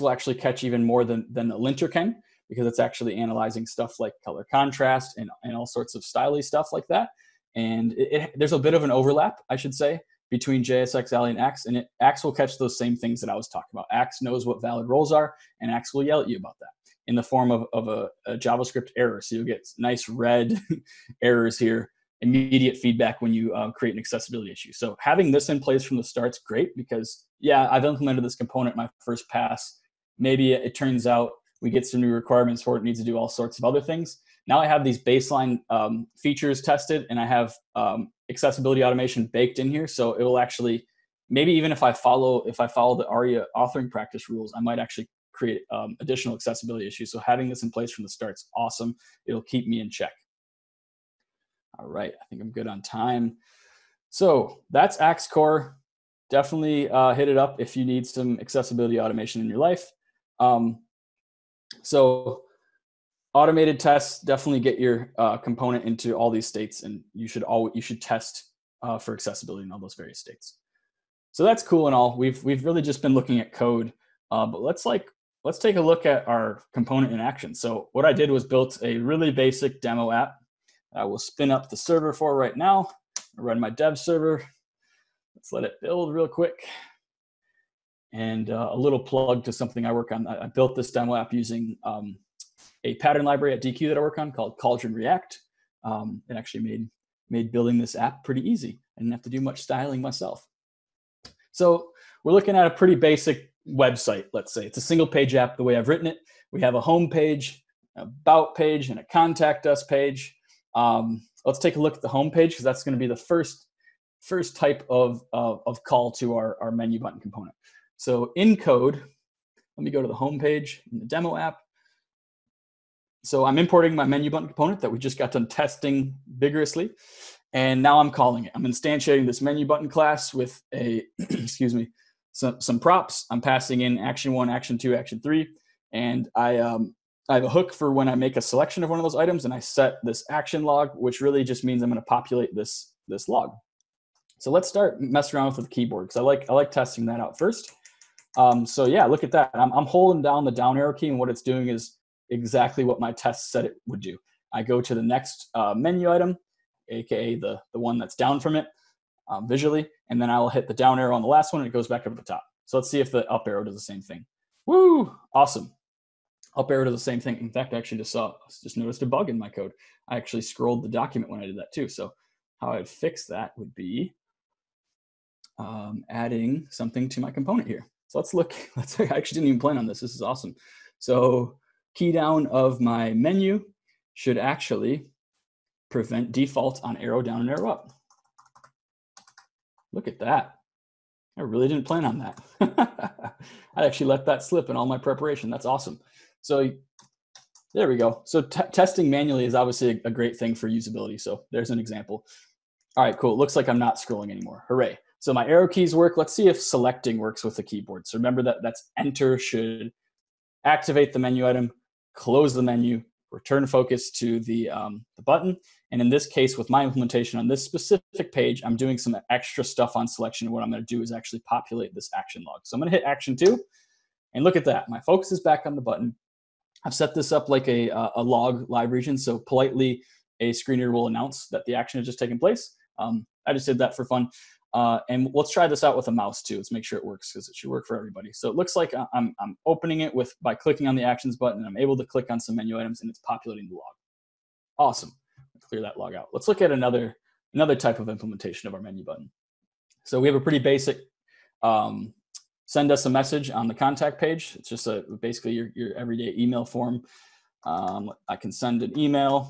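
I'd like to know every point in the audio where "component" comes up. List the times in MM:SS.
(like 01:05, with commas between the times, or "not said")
00:28, 01:05, 01:16, 01:57, 02:04, 02:57.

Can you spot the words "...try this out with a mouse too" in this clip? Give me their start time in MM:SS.
03:55.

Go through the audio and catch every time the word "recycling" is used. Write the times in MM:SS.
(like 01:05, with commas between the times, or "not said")
not said.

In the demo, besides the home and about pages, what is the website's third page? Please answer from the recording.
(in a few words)
contact us page.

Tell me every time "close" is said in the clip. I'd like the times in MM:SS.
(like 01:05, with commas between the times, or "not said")
03:32.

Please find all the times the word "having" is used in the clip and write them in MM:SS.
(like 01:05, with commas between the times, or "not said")
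00:24, 00:47.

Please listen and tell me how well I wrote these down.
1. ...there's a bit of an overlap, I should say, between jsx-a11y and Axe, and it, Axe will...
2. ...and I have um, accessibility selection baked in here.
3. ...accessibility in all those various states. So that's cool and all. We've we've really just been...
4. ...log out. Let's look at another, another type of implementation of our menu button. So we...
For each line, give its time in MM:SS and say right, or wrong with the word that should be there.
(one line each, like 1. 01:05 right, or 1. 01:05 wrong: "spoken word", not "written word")
1. 00:08 right
2. 00:37 wrong: "automation", not "selection"
3. 01:09 right
4. 04:05 right.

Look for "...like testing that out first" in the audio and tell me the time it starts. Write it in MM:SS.
02:26.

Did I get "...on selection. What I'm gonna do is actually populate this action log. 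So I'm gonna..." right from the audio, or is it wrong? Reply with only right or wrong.
right.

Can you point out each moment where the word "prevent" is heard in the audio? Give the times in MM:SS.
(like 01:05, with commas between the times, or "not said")
03:05.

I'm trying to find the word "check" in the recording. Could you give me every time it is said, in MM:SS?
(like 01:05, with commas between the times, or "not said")
00:49.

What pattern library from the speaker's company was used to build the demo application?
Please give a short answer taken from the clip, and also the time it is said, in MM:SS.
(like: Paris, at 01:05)
Cauldron React, at 01:34.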